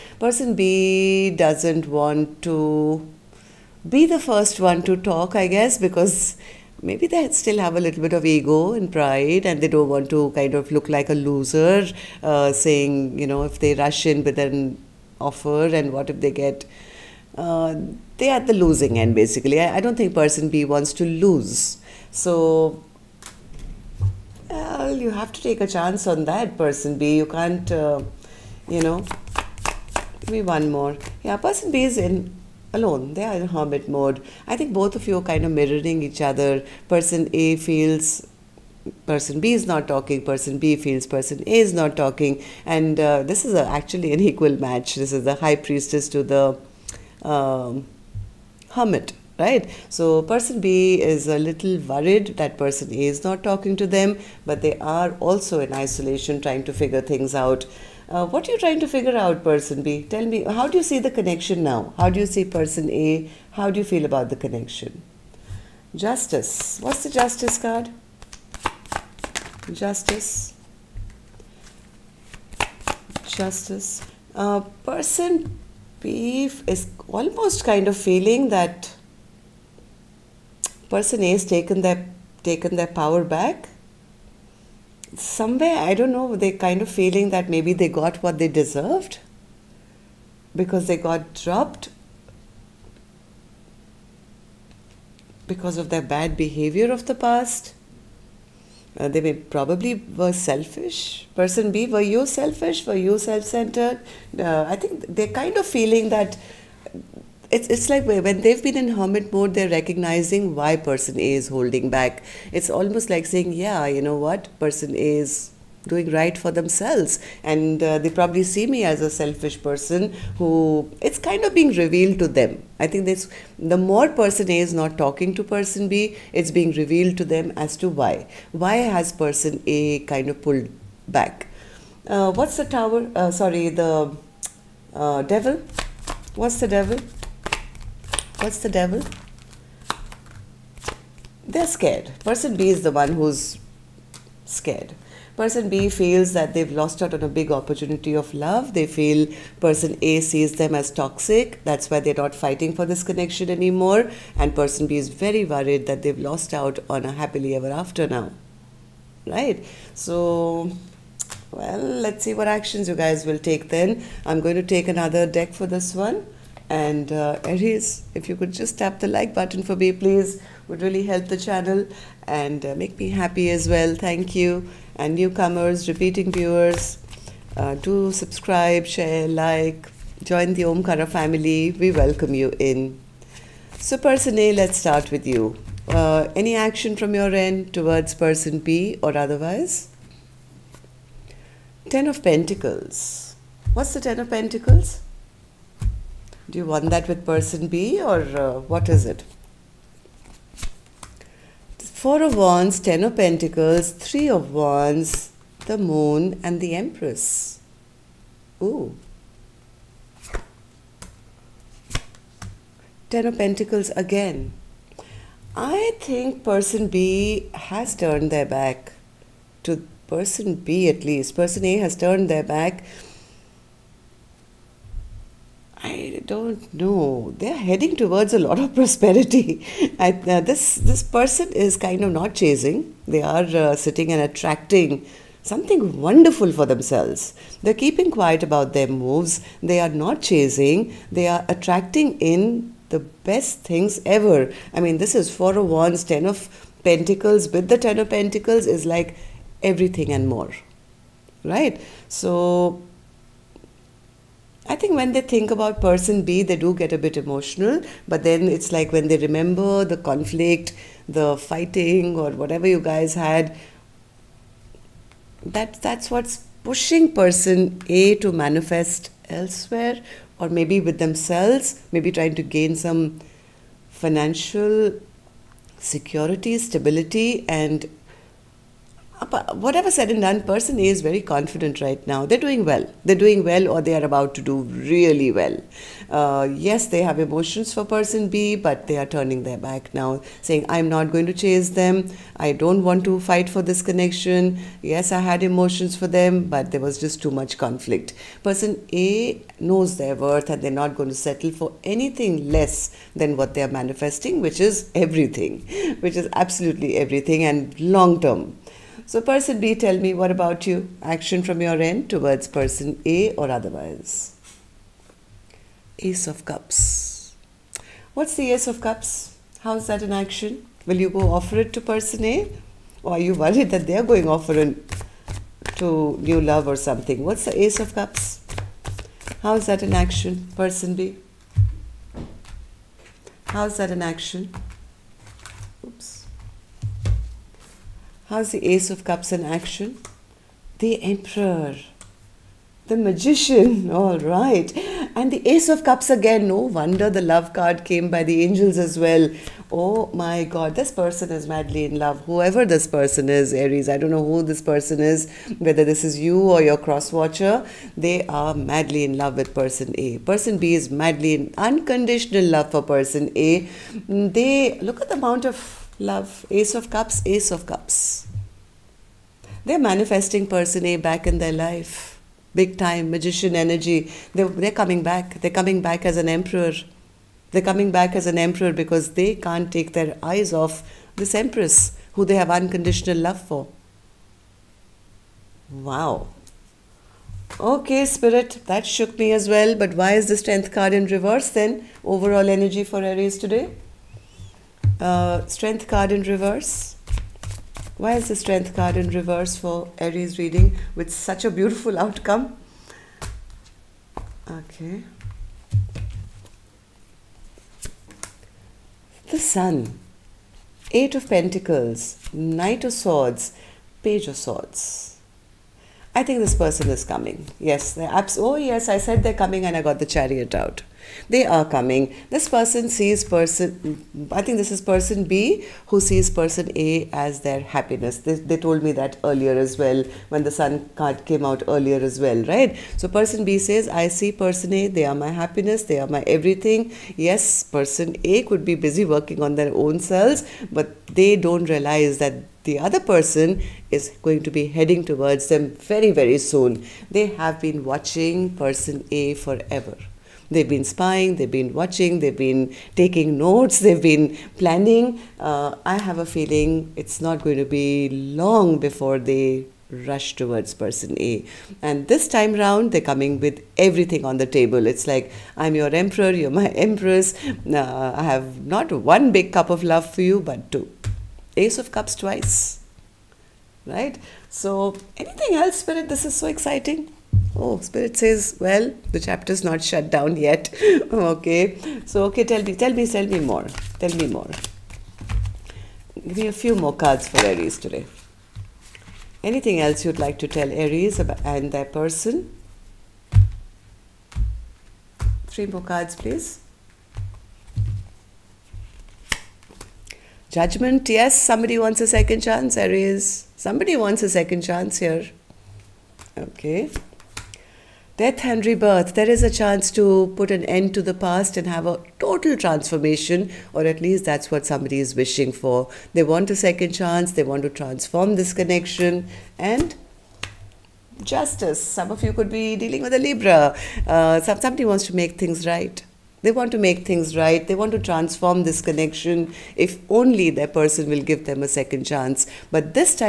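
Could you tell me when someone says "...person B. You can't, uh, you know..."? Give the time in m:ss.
0:26.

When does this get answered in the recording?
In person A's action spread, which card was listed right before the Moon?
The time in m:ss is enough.
3:23.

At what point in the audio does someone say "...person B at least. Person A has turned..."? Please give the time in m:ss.
3:40.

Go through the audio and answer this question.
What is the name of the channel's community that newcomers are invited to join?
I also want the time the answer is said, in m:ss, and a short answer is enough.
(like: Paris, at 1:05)
Omkara family, at 3:00.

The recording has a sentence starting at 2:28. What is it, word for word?
They feel person A sees them as toxic.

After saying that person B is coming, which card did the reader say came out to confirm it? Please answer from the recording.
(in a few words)
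The Chariot.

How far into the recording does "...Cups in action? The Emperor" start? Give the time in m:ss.
5:39.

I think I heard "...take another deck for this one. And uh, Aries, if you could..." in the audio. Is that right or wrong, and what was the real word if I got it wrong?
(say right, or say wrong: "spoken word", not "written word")
right.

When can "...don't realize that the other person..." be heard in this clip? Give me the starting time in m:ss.
7:21.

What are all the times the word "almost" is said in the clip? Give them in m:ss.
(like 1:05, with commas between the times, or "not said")
1:17, 1:52.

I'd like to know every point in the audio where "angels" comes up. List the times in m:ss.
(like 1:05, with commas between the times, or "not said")
5:48.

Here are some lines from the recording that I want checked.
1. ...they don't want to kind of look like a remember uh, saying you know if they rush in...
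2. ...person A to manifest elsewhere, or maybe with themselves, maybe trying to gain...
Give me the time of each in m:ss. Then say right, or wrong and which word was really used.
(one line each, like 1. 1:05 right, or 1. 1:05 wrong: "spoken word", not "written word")
1. 0:09 wrong: "loser", not "remember"
2. 4:27 right.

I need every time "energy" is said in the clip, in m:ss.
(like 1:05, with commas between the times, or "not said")
6:13, 6:32.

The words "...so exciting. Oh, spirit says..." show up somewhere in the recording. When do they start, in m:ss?
7:56.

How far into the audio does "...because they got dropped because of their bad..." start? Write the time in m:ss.
1:30.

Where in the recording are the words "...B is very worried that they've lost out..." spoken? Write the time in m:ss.
2:34.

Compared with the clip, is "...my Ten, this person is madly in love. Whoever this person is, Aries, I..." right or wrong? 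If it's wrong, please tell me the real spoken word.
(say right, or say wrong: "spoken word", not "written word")
wrong: "God", not "Ten".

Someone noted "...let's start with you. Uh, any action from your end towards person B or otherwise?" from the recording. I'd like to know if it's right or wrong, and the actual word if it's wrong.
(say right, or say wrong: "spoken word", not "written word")
right.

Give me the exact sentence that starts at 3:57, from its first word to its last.
They're keeping quiet about their moves.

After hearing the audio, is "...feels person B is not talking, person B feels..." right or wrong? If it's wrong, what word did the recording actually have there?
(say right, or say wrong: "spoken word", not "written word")
right.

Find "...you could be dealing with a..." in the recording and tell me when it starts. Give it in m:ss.
8:42.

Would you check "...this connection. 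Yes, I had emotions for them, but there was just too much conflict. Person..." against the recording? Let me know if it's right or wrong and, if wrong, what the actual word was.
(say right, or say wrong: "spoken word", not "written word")
right.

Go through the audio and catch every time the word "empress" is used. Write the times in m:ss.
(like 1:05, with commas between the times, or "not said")
3:26, 6:21, 7:46.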